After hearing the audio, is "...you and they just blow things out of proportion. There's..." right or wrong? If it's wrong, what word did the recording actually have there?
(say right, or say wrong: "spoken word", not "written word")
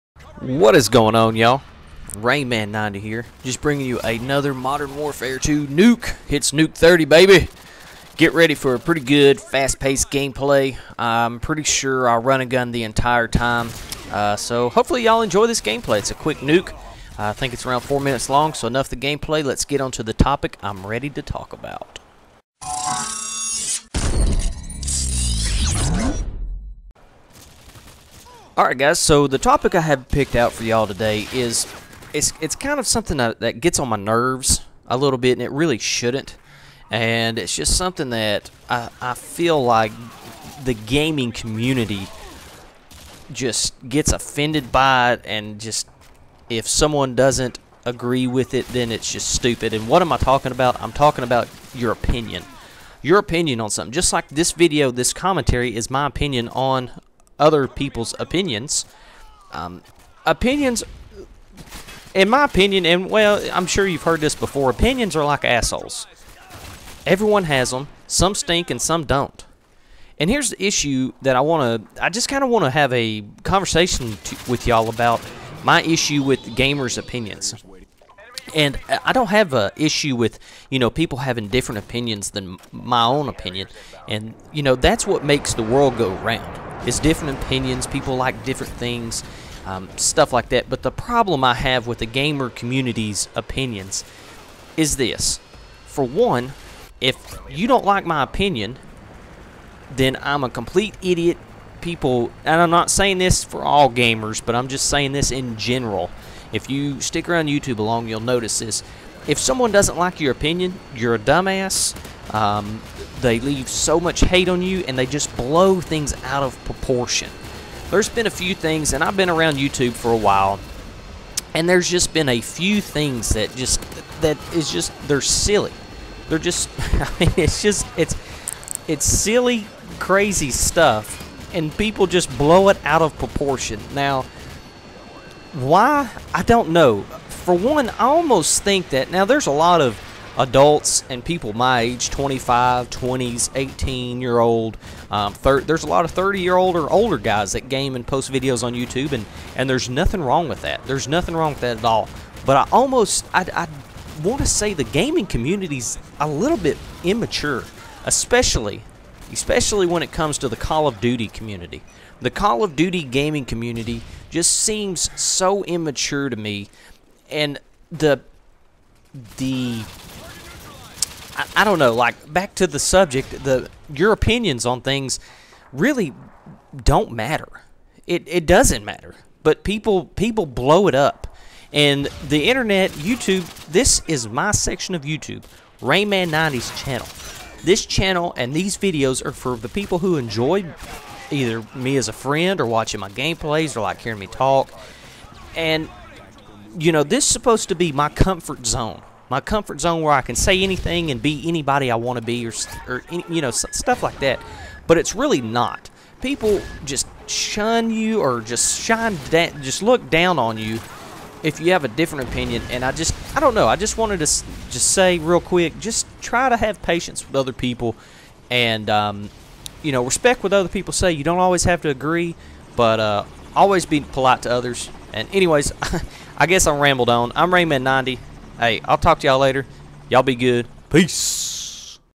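right.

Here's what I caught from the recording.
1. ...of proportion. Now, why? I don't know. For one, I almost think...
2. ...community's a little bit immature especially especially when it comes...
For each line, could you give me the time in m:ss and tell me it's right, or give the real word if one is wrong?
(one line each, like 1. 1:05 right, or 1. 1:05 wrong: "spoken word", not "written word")
1. 2:13 right
2. 2:35 right.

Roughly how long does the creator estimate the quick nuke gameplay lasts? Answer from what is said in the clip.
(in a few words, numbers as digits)
4 minutes.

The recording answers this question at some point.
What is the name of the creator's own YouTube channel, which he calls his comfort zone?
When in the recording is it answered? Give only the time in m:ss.
3:05.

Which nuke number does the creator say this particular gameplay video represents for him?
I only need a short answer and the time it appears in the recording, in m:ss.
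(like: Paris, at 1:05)
30, at 0:06.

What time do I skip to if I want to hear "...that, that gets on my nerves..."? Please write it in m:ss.
0:33.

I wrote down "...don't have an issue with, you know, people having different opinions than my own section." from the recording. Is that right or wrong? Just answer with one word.
wrong.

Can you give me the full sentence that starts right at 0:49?
And what am I talking about?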